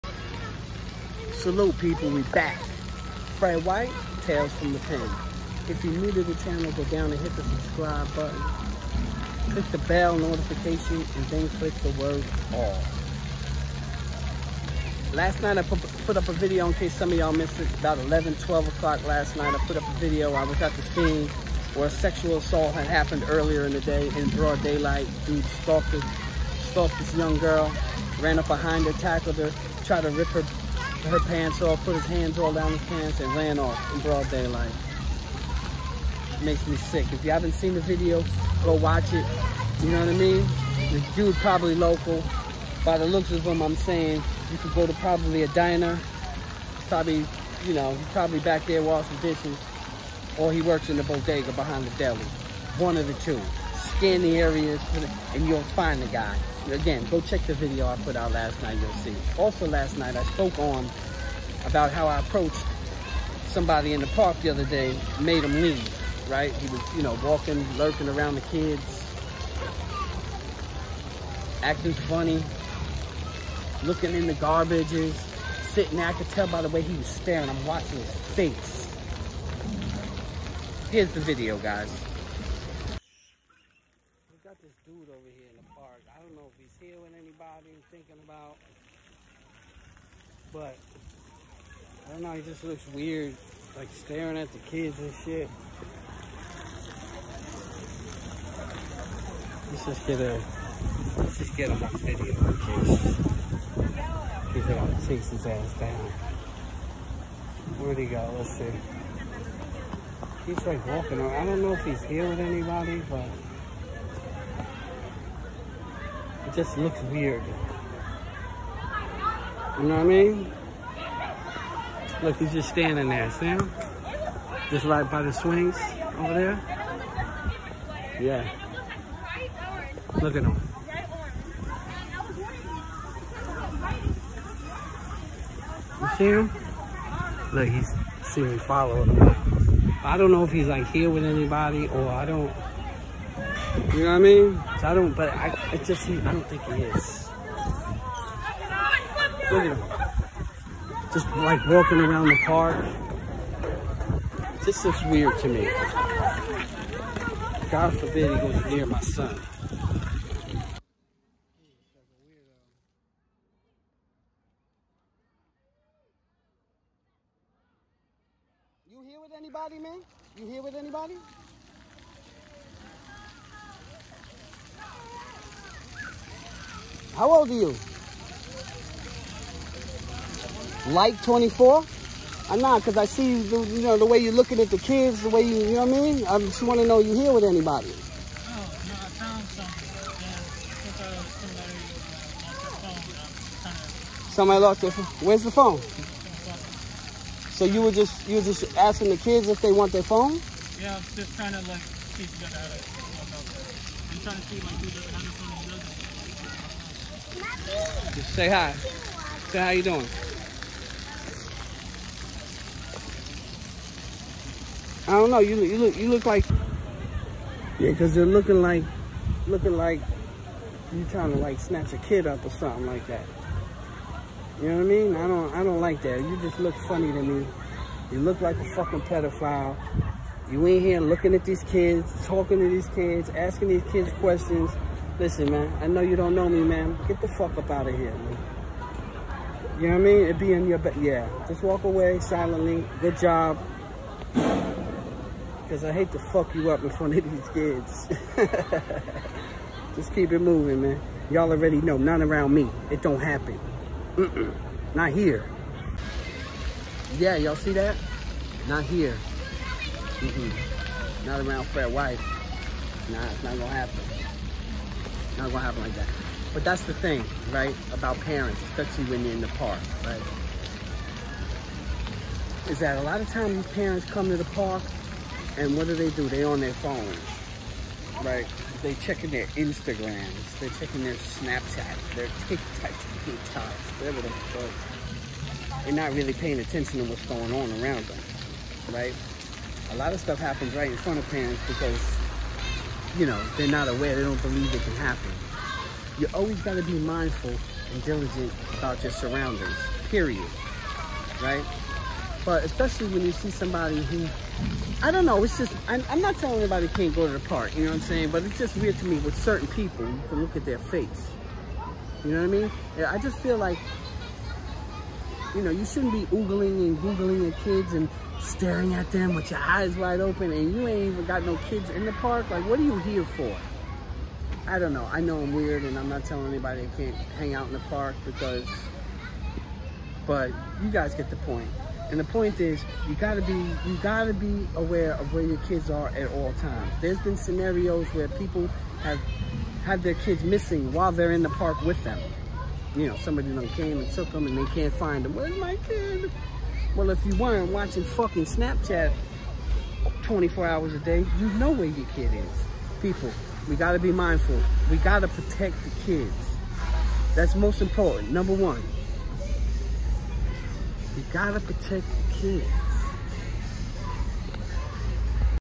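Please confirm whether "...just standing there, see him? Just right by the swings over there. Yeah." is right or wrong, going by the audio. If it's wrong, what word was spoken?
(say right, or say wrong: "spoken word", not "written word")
right.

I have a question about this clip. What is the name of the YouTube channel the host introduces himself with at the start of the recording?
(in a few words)
Tales from the Pen.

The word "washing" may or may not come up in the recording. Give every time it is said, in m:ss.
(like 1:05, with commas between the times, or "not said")
0:48.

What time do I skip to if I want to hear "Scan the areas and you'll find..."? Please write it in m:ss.
0:53.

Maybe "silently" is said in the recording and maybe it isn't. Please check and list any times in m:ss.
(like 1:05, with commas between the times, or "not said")
4:02.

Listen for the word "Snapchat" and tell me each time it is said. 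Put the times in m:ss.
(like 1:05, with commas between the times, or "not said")
4:41, 5:48.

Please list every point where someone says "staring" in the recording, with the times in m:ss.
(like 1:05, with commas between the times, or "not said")
1:17, 1:33, 5:18.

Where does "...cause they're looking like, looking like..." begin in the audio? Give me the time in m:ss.
3:37.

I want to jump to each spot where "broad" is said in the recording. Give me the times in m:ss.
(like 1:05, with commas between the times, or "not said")
0:24, 0:34.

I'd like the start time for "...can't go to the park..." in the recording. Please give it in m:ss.
5:06.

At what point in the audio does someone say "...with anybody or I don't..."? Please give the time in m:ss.
2:21.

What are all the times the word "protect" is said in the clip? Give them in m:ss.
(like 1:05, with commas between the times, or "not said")
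5:55, 6:01.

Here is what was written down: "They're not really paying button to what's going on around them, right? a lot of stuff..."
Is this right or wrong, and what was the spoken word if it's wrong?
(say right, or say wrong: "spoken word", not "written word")
wrong: "attention", not "button".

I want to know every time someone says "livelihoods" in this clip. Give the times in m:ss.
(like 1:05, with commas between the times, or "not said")
not said.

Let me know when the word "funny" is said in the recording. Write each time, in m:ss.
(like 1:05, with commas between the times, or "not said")
1:11, 3:46.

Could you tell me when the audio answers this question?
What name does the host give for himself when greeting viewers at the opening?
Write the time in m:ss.
0:03.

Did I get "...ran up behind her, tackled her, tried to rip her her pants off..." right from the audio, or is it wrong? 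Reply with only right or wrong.
right.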